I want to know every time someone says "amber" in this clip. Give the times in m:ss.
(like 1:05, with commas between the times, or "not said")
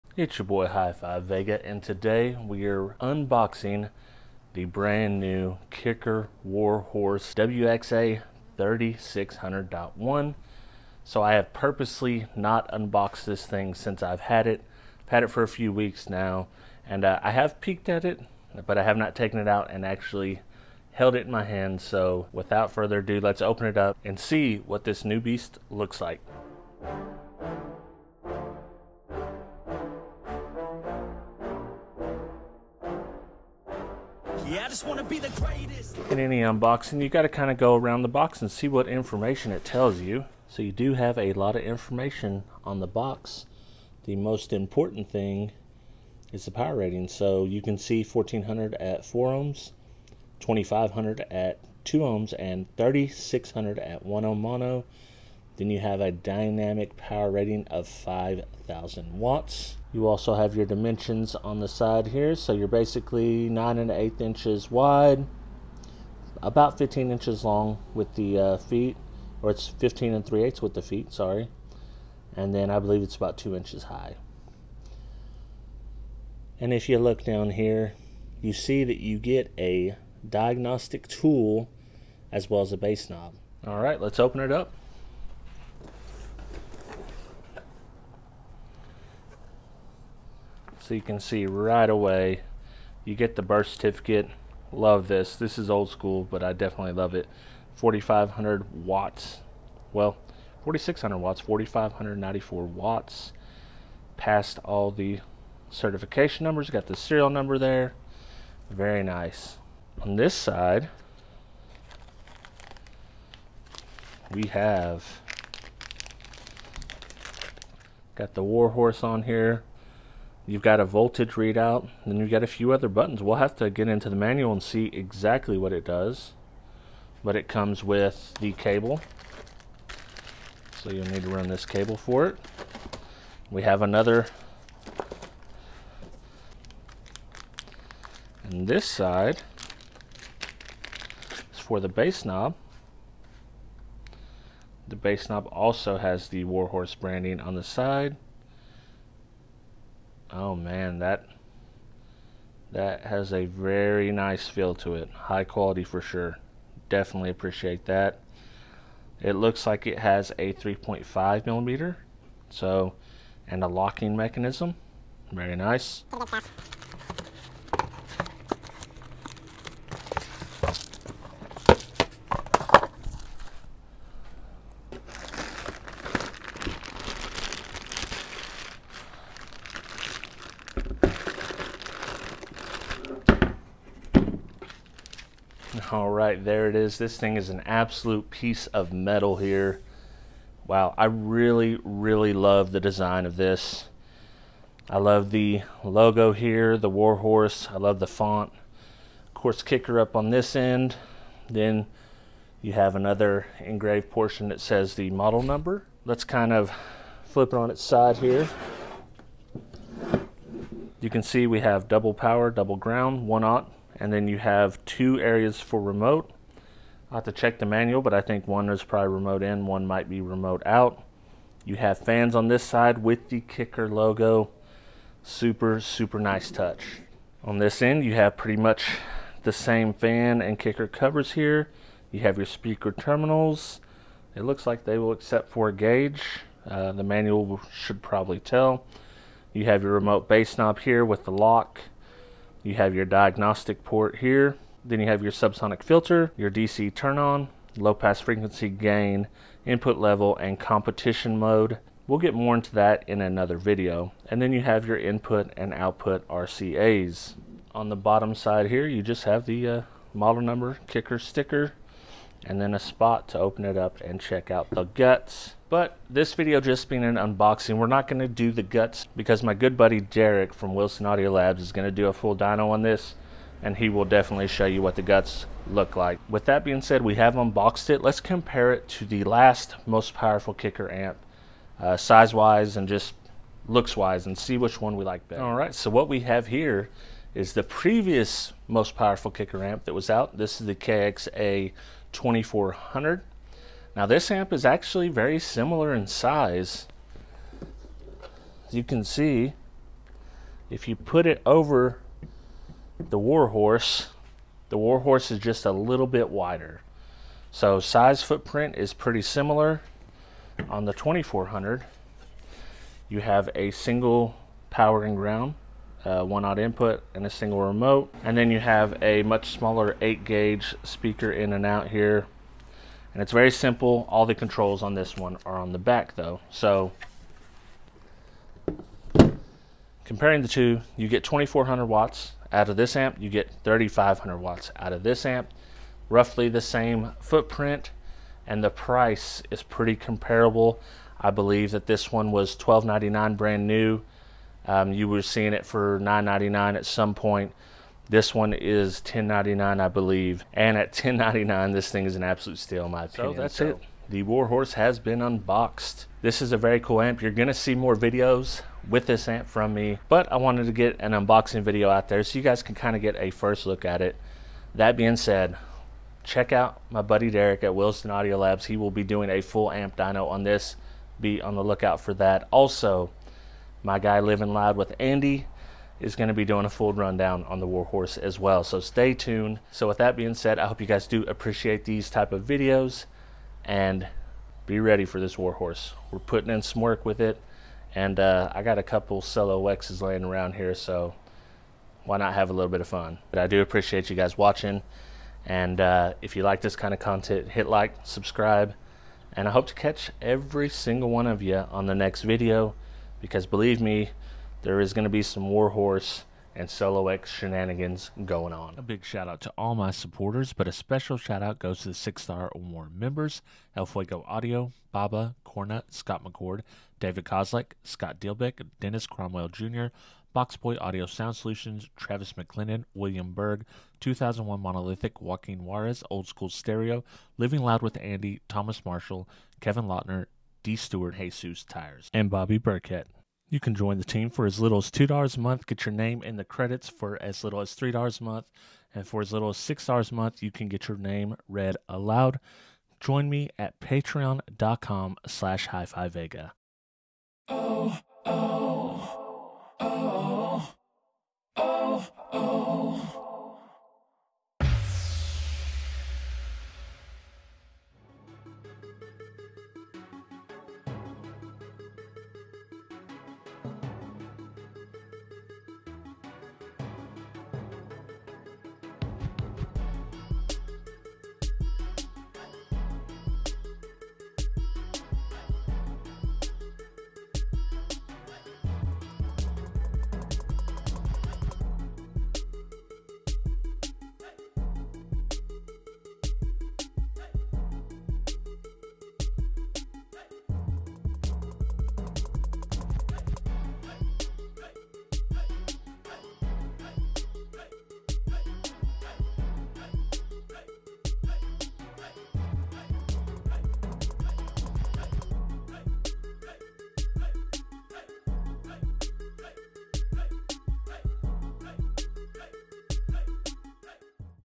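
not said.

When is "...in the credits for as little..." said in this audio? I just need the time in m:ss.
7:16.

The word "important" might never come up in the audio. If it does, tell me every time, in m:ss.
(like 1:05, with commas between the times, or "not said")
0:44.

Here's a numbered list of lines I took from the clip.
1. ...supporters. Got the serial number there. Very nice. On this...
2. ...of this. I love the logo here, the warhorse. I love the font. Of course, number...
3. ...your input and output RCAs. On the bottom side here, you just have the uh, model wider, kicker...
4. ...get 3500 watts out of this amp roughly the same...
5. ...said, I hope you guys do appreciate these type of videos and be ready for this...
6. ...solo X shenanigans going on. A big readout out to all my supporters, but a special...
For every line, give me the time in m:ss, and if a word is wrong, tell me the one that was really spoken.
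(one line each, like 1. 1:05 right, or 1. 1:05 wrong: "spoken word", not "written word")
1. 1:46 wrong: "numbers", not "supporters"
2. 3:13 wrong: "kicker", not "number"
3. 4:14 wrong: "number", not "wider"
4. 5:33 right
5. 6:20 right
6. 6:46 wrong: "shout", not "readout".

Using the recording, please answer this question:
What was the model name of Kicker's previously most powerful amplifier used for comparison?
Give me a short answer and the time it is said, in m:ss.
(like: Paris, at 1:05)
KXA 2400, at 4:50.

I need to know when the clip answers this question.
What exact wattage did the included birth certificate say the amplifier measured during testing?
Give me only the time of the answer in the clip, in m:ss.
1:41.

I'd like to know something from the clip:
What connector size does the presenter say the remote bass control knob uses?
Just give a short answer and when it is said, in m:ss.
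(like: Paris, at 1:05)
3.5 millimeter, at 2:40.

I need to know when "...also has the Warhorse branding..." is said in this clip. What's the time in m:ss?
2:25.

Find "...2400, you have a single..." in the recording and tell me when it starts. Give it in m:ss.
5:10.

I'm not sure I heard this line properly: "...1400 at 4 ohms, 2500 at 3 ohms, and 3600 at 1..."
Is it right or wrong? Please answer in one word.
wrong.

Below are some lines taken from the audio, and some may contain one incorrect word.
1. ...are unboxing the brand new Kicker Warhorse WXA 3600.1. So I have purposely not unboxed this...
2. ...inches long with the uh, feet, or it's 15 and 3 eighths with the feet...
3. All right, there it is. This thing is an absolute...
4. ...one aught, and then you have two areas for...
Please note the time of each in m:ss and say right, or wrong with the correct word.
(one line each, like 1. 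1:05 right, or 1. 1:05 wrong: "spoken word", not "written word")
1. 0:02 right
2. 1:07 right
3. 3:05 right
4. 3:33 right.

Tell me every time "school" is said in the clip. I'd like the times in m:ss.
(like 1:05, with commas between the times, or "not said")
1:35, 7:06.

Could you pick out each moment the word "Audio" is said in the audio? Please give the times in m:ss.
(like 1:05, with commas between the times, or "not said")
4:31, 6:08, 6:54, 7:00.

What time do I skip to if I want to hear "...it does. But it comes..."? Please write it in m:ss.
2:05.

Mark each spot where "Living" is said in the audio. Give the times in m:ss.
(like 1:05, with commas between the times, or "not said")
6:14, 7:07.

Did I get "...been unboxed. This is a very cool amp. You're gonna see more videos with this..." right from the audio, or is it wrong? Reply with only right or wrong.
right.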